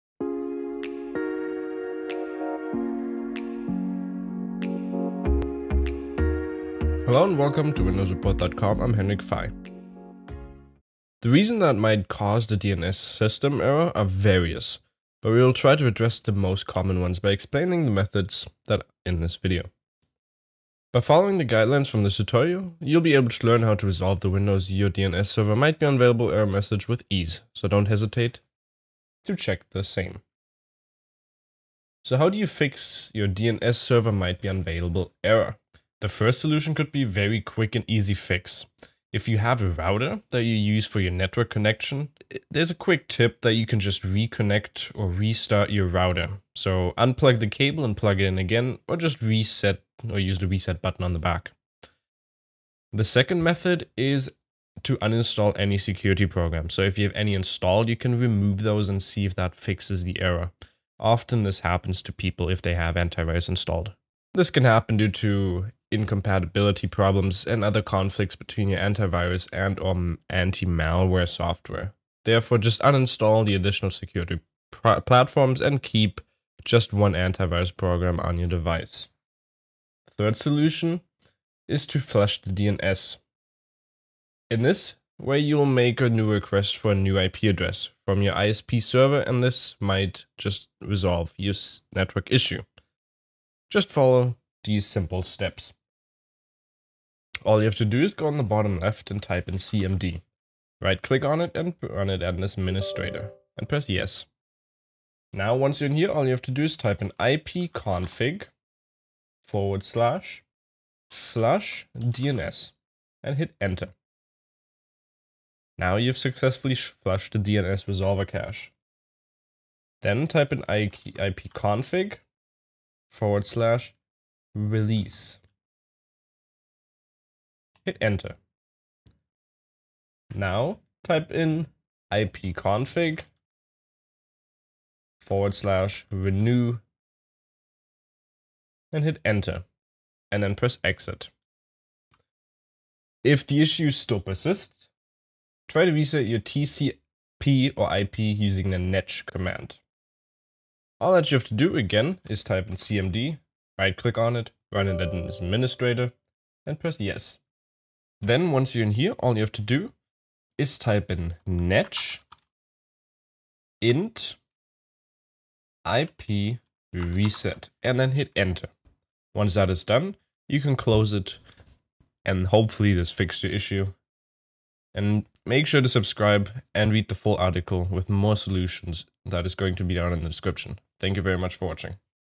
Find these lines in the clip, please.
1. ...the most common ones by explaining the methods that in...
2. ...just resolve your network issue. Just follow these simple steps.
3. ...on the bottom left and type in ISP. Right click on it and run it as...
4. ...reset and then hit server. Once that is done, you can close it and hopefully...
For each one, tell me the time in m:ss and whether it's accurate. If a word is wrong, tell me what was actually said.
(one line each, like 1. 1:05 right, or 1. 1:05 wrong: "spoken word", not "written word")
1. 0:16 right
2. 1:30 right
3. 1:38 wrong: "CMD", not "ISP"
4. 2:46 wrong: "enter", not "server".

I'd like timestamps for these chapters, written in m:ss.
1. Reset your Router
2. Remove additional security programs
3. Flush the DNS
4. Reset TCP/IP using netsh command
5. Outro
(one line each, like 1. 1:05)
1. 0:35
2. 0:55
3. 1:18
4. 2:20
5. 2:50.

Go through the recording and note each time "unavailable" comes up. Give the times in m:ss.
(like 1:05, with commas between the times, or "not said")
0:25, 0:34.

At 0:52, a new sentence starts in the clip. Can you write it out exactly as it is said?
The second method is to uninstall any security program.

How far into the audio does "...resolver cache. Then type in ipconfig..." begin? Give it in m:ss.
1:57.